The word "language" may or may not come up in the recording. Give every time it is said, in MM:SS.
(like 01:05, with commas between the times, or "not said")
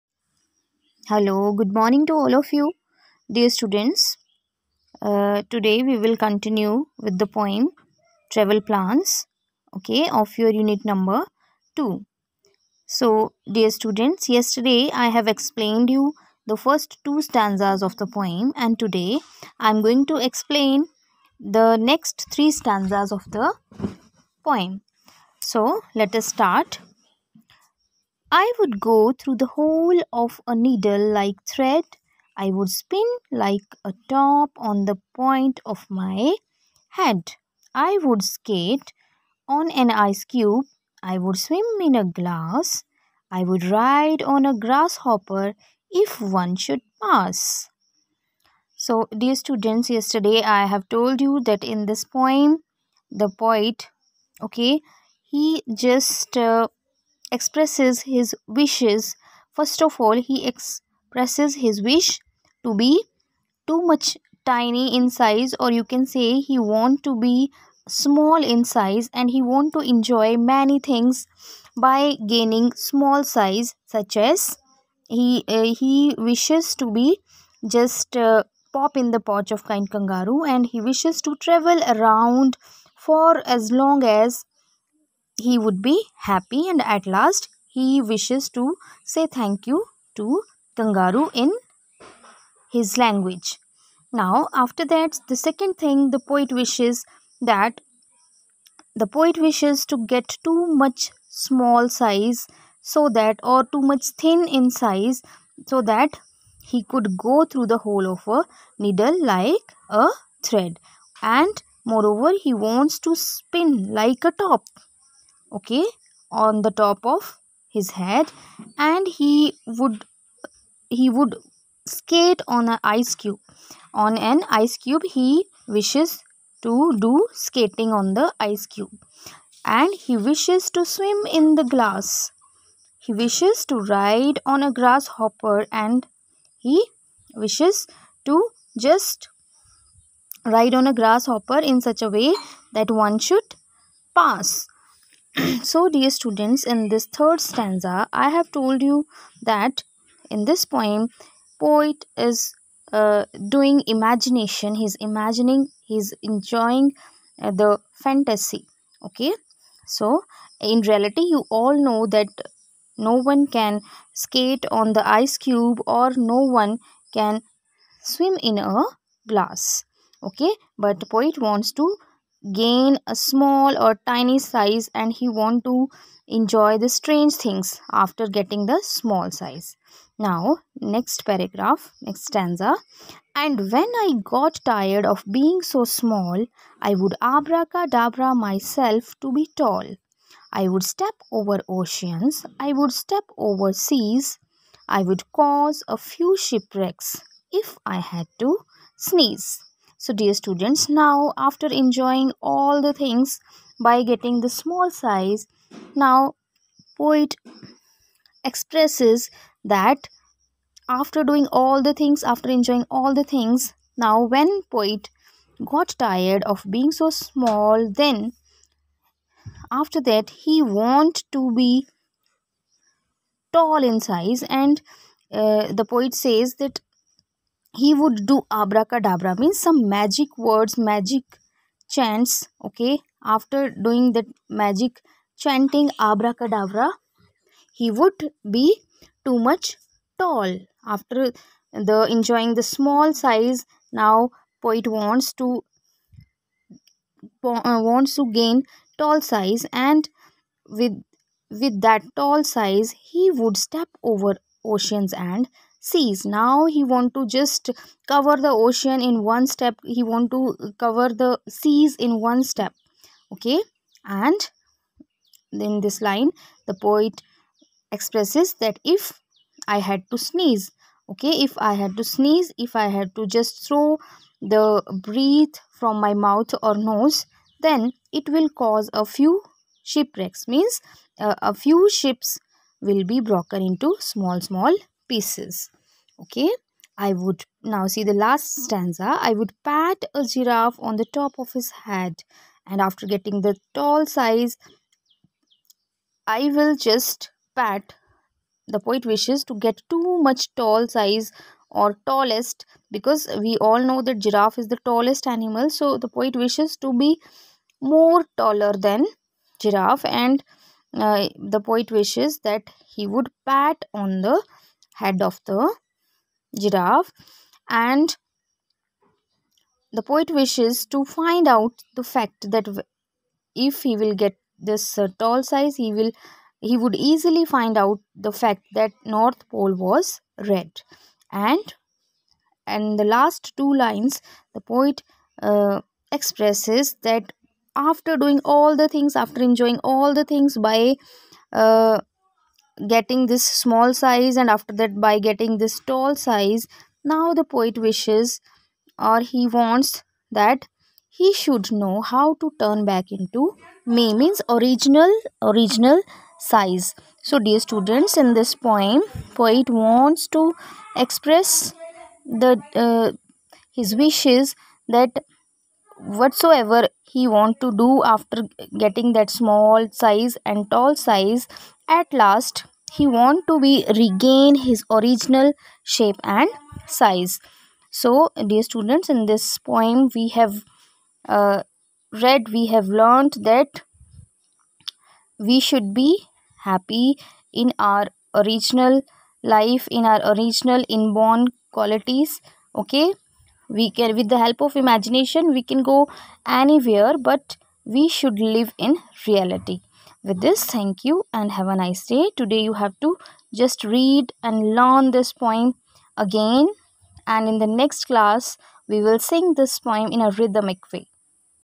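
01:32.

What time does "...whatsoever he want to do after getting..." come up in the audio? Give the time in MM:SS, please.
06:06.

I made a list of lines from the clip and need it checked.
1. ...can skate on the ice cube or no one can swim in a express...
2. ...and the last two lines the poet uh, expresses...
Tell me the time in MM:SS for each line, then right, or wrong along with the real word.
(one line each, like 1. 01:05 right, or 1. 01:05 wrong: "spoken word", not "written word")
1. 02:43 wrong: "glass", not "express"
2. 05:32 right.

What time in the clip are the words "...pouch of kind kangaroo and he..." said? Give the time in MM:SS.
01:19.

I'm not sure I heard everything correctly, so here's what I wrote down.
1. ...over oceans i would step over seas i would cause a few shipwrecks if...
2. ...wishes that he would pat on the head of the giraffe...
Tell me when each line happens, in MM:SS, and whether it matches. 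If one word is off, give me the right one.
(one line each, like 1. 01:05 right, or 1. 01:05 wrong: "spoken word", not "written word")
1. 03:11 right
2. 05:12 right.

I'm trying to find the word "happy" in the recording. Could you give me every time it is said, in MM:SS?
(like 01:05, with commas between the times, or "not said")
01:26, 06:26.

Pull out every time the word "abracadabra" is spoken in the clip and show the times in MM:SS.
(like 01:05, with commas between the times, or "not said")
03:07, 03:48, 03:55.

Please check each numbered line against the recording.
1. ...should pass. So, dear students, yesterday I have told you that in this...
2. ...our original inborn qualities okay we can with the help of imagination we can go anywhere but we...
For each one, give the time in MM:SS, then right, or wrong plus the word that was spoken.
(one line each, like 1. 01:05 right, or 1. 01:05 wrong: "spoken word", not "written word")
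1. 00:46 right
2. 06:30 right.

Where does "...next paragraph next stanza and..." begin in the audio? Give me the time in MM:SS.
03:00.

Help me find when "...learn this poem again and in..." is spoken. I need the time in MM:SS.
06:44.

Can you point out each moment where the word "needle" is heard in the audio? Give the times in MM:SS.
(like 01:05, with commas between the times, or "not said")
00:30, 01:48.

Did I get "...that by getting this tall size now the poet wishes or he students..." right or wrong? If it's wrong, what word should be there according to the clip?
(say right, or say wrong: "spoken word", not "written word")
wrong: "wants", not "students".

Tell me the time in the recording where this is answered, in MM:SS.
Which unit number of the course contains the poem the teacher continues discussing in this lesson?
00:10.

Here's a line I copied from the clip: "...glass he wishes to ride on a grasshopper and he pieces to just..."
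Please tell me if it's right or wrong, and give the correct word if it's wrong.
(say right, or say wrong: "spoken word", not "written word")
wrong: "wishes", not "pieces".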